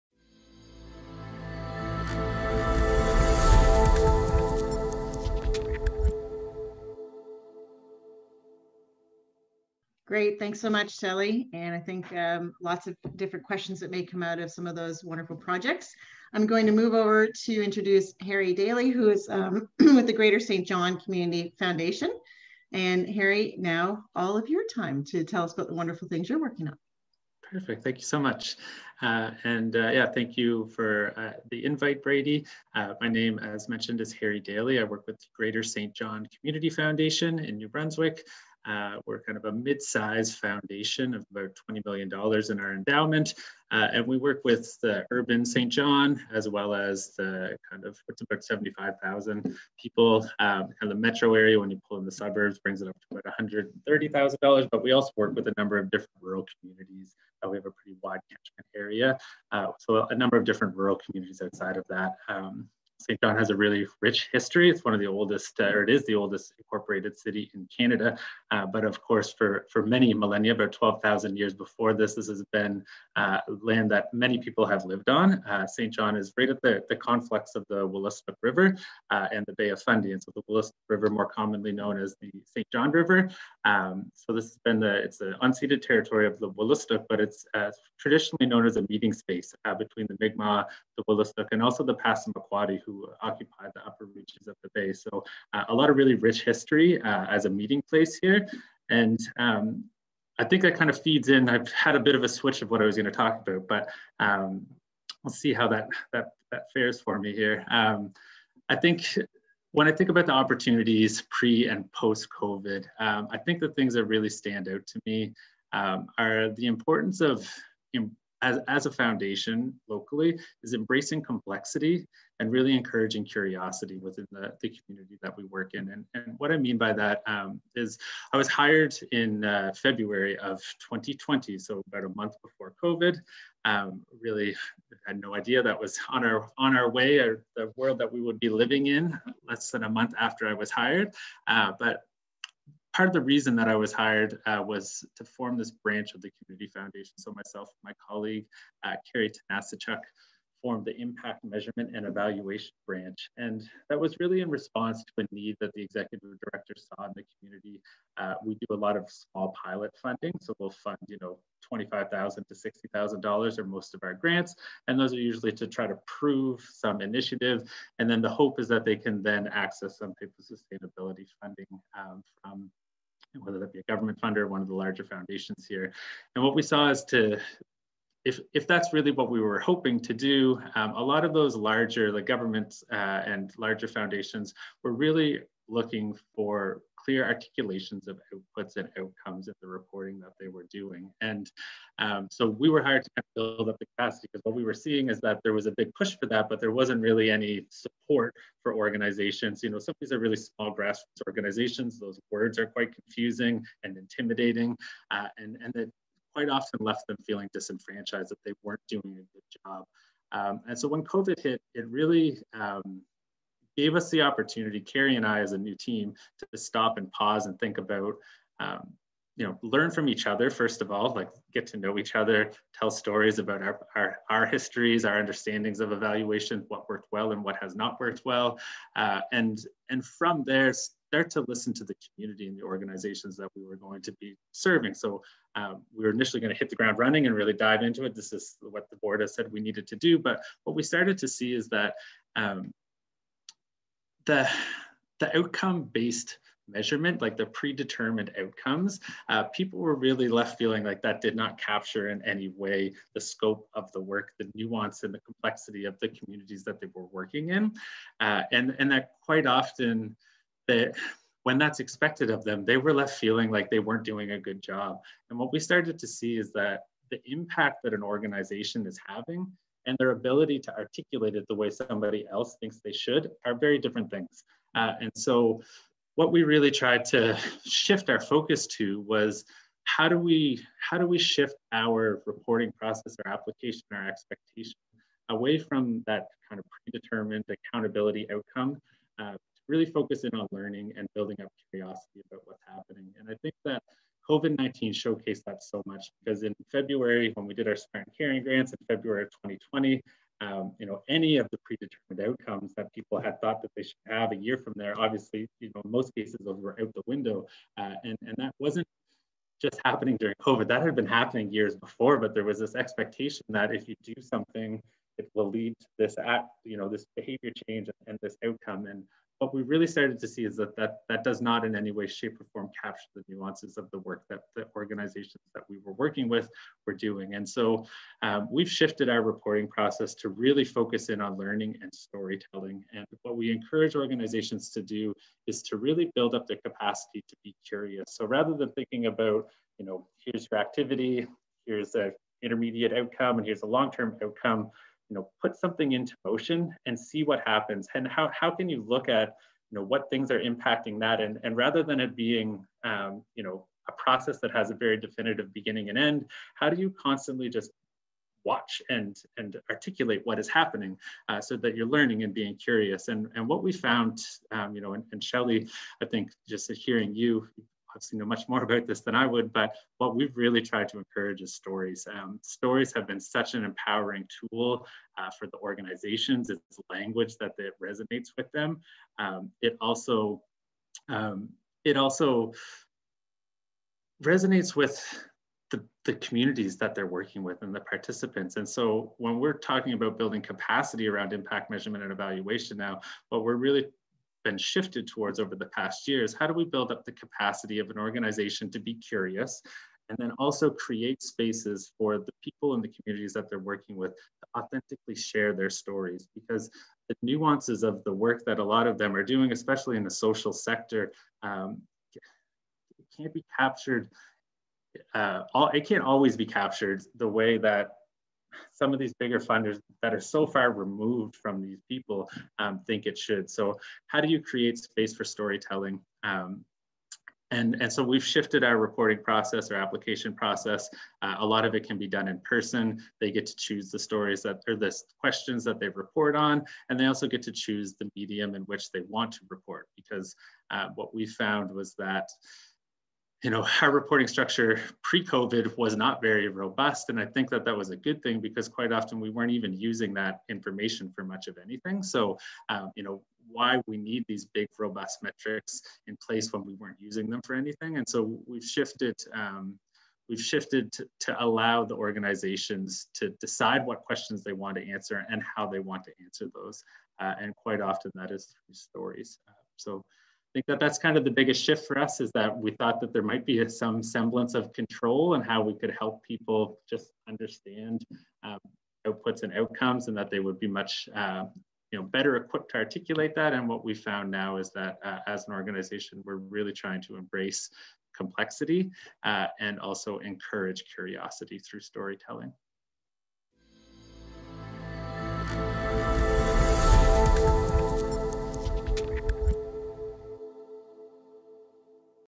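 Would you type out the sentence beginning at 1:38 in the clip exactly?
And um, I think that kind of feeds in.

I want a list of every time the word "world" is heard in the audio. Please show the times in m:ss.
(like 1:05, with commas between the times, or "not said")
2:17.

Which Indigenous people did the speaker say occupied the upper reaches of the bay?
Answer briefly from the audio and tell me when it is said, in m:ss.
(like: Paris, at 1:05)
Passamaquoddy, at 1:31.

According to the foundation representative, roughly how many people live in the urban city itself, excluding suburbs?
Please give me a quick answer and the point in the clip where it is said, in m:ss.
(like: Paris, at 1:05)
75,000, at 0:48.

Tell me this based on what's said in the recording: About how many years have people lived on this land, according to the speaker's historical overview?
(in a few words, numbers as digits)
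12,000.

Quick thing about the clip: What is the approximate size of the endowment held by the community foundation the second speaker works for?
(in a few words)
$20 million.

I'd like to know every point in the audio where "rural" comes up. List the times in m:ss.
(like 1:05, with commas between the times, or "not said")
0:56, 1:00.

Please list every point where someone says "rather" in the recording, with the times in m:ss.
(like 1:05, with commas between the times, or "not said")
5:38, 5:51.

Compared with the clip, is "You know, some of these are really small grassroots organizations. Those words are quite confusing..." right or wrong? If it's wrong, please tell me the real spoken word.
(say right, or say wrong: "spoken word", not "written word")
right.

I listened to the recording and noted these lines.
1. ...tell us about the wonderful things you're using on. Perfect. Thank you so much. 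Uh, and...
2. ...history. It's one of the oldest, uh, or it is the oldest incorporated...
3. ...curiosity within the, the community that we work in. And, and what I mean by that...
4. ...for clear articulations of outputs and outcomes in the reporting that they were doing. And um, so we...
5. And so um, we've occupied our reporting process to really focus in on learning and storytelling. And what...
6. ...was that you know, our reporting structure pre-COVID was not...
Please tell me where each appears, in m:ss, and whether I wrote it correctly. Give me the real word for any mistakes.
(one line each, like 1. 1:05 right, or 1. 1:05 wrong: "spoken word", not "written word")
1. 0:25 wrong: "working", not "using"
2. 1:04 right
3. 2:03 right
4. 3:06 right
5. 5:27 wrong: "shifted", not "occupied"
6. 7:21 right.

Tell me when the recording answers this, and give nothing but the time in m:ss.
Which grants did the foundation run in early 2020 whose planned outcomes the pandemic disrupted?
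4:57.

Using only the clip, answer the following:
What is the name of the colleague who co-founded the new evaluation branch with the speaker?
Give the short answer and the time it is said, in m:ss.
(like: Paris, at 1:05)
Carrie Tanasichuk, at 2:29.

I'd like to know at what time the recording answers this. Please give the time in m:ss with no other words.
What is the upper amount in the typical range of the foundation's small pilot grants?
2:42.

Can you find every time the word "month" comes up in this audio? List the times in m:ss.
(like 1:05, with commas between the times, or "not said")
2:12, 2:19.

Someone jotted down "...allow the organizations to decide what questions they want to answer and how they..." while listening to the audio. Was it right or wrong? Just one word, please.
right.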